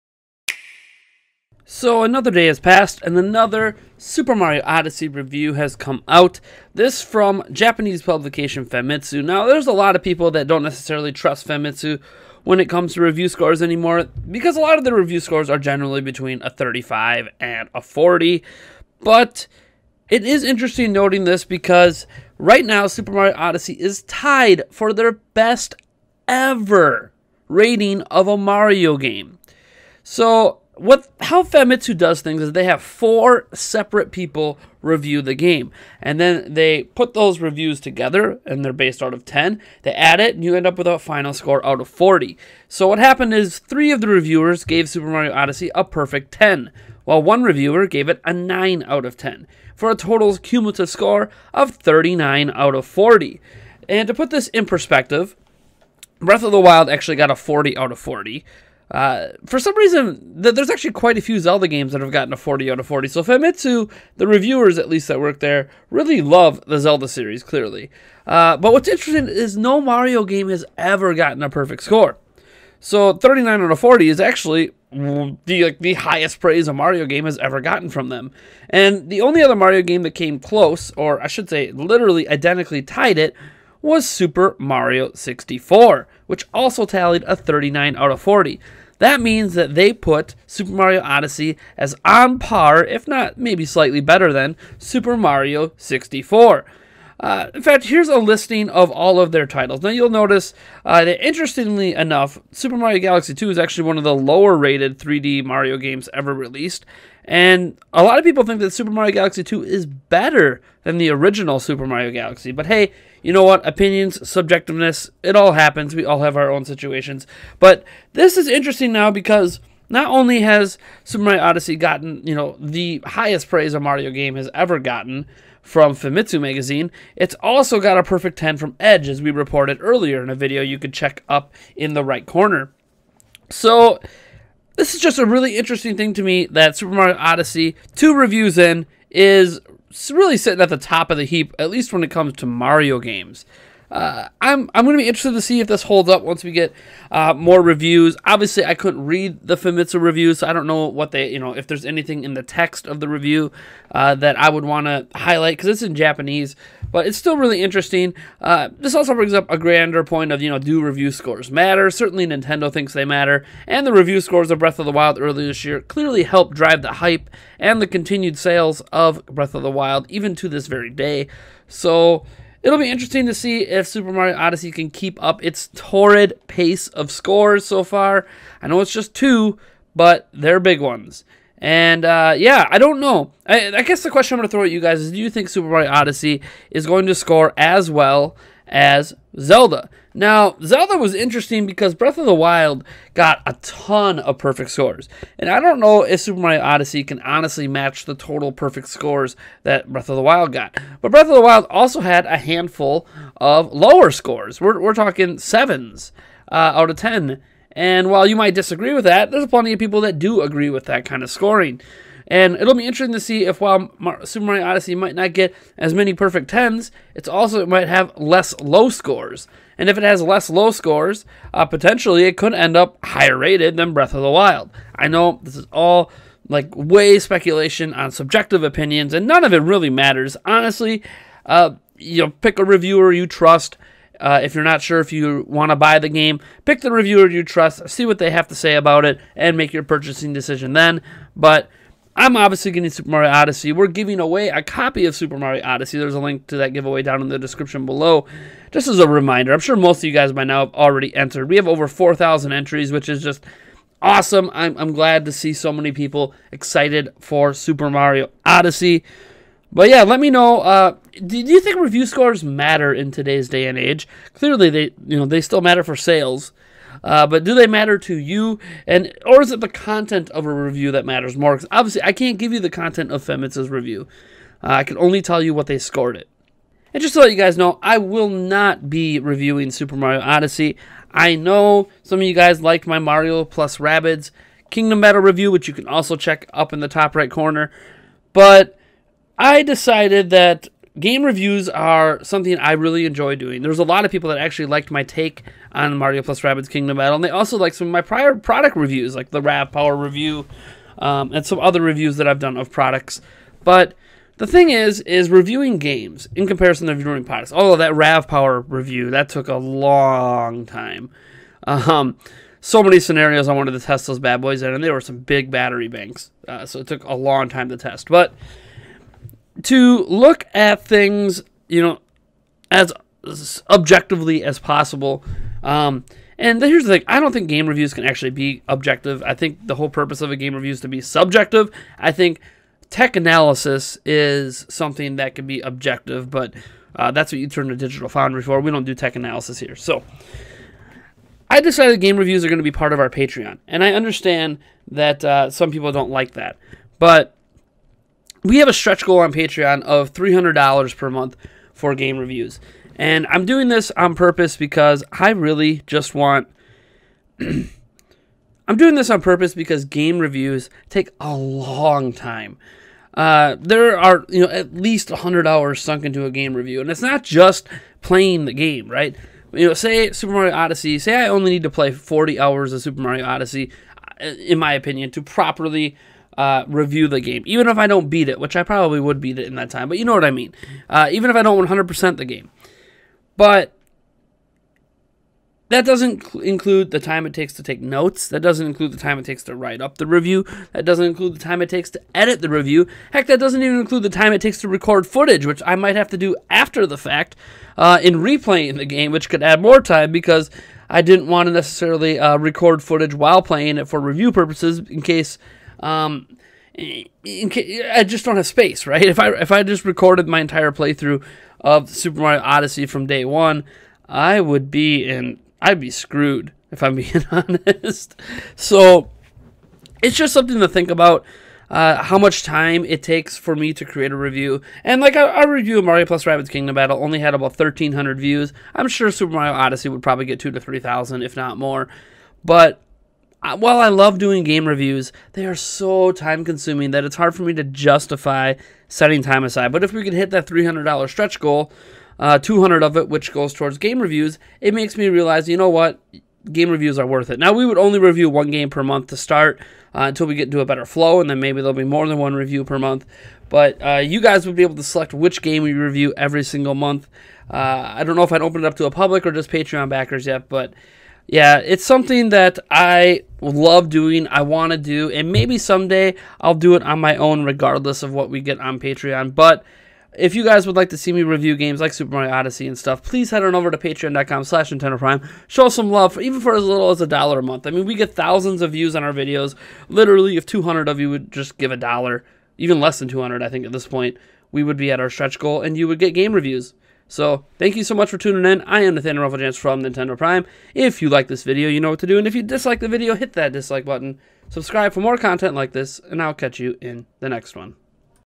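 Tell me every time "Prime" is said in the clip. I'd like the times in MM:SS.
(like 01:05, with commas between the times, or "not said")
07:54, 08:10.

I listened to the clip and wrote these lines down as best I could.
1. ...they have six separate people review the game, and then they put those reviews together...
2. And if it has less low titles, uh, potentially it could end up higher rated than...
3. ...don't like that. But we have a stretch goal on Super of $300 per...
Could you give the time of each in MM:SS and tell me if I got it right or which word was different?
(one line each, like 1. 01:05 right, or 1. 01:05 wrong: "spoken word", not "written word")
1. 00:32 wrong: "four", not "six"
2. 03:39 wrong: "scores", not "titles"
3. 05:45 wrong: "Patreon", not "Super".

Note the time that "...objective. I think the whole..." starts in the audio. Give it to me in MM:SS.
05:28.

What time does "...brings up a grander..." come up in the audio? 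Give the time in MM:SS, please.
02:39.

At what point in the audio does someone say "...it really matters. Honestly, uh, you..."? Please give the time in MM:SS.
03:49.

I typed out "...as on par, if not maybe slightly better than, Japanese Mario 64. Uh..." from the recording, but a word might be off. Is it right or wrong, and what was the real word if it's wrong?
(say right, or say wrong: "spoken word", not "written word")
wrong: "Super", not "Japanese".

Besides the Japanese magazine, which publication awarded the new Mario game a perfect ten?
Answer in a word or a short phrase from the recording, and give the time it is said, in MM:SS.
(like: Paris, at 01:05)
Edge, at 02:08.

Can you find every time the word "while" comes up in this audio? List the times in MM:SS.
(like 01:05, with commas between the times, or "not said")
00:47, 03:28, 03:33, 06:43, 07:13.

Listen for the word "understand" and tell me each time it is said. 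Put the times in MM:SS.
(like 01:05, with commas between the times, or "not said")
05:43.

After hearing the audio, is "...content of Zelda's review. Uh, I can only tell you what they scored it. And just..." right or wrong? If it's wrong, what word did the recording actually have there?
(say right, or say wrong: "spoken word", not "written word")
wrong: "Famitsu", not "Zelda".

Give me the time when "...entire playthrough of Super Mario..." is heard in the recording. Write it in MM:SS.
06:50.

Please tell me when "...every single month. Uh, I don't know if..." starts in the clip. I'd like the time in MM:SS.
07:36.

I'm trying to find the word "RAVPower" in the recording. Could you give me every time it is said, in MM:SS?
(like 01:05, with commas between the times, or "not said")
04:59, 05:07.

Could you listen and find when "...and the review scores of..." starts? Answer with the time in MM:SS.
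02:43.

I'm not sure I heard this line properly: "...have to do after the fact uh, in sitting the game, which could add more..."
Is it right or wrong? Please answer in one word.
wrong.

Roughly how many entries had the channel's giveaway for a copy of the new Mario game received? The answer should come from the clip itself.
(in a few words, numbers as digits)
Over 4,000.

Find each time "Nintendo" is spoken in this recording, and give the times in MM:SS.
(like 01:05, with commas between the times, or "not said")
02:42, 07:54, 08:09.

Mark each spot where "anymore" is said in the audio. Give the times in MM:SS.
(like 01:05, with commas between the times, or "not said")
00:13.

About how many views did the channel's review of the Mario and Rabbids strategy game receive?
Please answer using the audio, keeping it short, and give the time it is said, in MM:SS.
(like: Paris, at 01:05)
1,300, at 07:07.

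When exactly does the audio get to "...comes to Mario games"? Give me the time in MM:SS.
02:22.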